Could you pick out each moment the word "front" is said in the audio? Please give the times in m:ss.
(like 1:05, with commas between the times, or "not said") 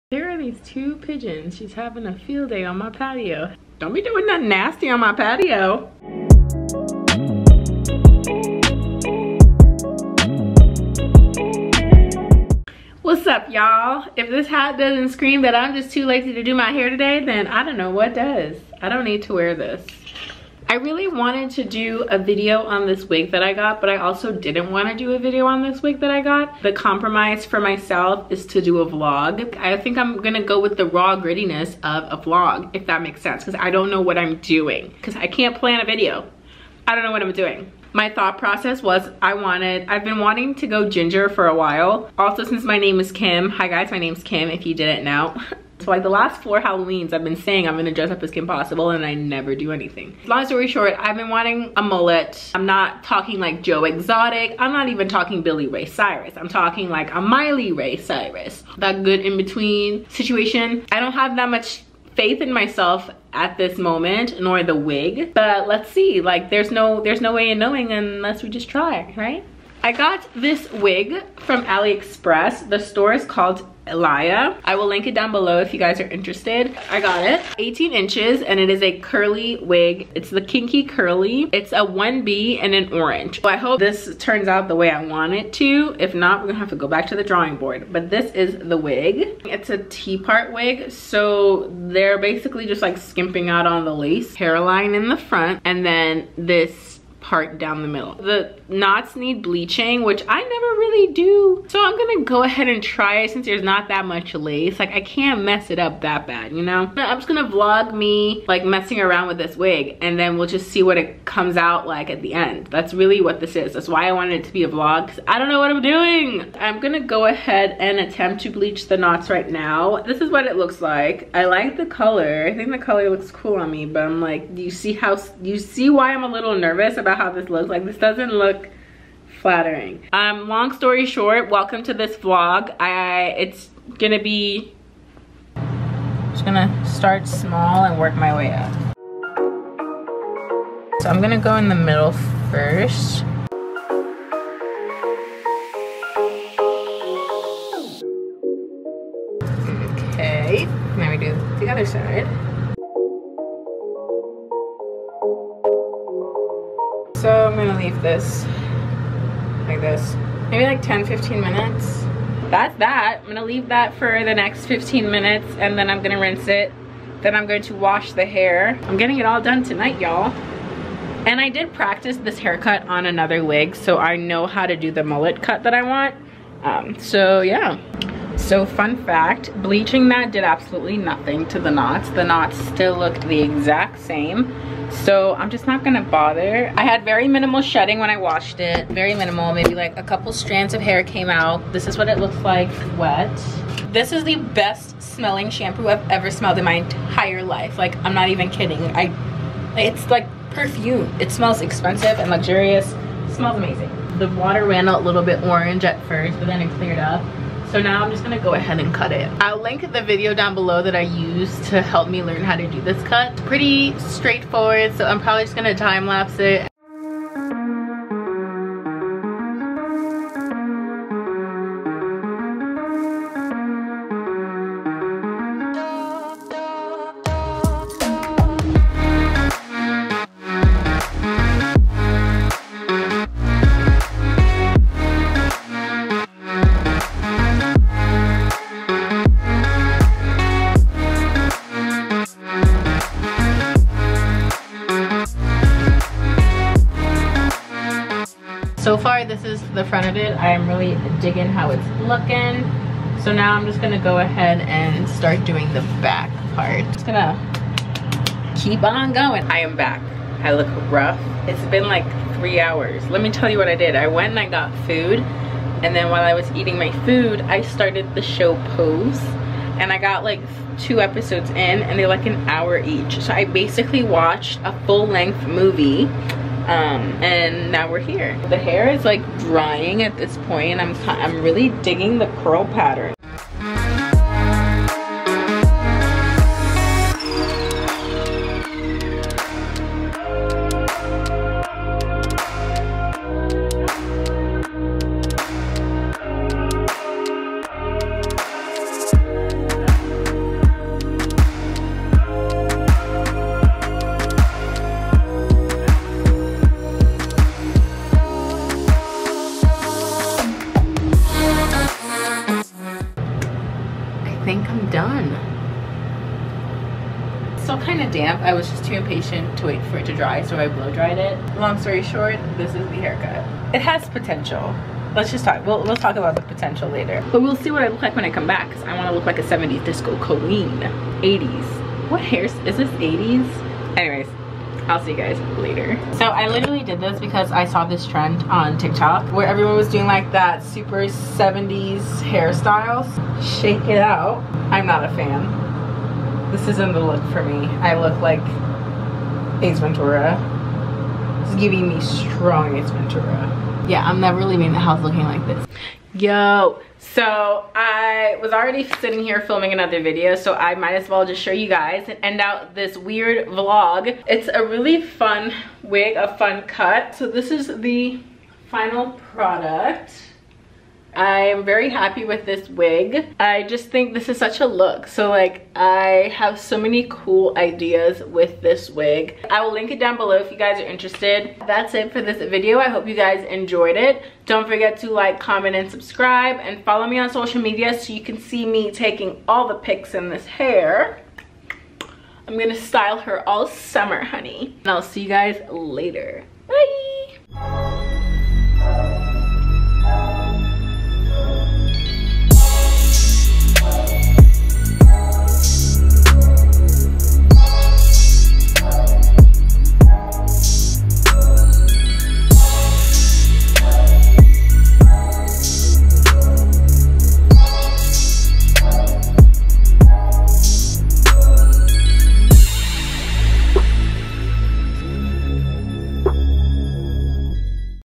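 1:35, 4:09.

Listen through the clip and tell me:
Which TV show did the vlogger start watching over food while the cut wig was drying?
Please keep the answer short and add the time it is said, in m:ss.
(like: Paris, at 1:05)
Pose, at 4:28.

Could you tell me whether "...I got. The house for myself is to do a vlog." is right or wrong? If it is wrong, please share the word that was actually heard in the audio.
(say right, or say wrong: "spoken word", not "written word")
wrong: "compromise", not "house".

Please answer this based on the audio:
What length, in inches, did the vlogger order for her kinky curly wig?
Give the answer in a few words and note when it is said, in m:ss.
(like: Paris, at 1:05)
18, at 1:17.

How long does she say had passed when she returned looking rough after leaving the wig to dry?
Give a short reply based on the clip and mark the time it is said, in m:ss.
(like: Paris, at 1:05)
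three hours, at 4:22.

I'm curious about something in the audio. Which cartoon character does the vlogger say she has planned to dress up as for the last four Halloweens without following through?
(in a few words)
Kim Possible.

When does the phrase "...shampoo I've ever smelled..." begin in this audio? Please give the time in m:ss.
3:15.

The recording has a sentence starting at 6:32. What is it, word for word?
I'm gonna style her all summer, honey.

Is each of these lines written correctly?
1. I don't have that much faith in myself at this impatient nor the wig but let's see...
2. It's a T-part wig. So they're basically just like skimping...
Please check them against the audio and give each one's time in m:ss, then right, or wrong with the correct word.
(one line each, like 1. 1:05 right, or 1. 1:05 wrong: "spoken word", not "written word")
1. 1:00 wrong: "moment", not "impatient"
2. 1:29 right.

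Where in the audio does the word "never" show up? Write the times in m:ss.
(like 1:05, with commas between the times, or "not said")
0:49, 1:40, 5:54.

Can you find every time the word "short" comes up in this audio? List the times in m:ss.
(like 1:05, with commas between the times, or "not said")
0:50, 2:11, 5:22.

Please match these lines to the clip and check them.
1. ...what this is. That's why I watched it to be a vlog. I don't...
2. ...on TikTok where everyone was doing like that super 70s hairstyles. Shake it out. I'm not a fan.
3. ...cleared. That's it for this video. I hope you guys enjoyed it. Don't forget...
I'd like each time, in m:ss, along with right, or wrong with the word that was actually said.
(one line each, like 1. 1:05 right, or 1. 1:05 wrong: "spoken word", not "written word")
1. 1:53 wrong: "wanted", not "watched"
2. 5:38 right
3. 6:20 wrong: "interested", not "cleared".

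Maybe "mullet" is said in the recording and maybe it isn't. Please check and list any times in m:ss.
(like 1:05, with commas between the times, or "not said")
0:51, 2:55.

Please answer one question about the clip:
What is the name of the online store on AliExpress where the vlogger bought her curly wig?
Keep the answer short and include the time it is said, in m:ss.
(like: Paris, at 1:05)
Elia, at 1:13.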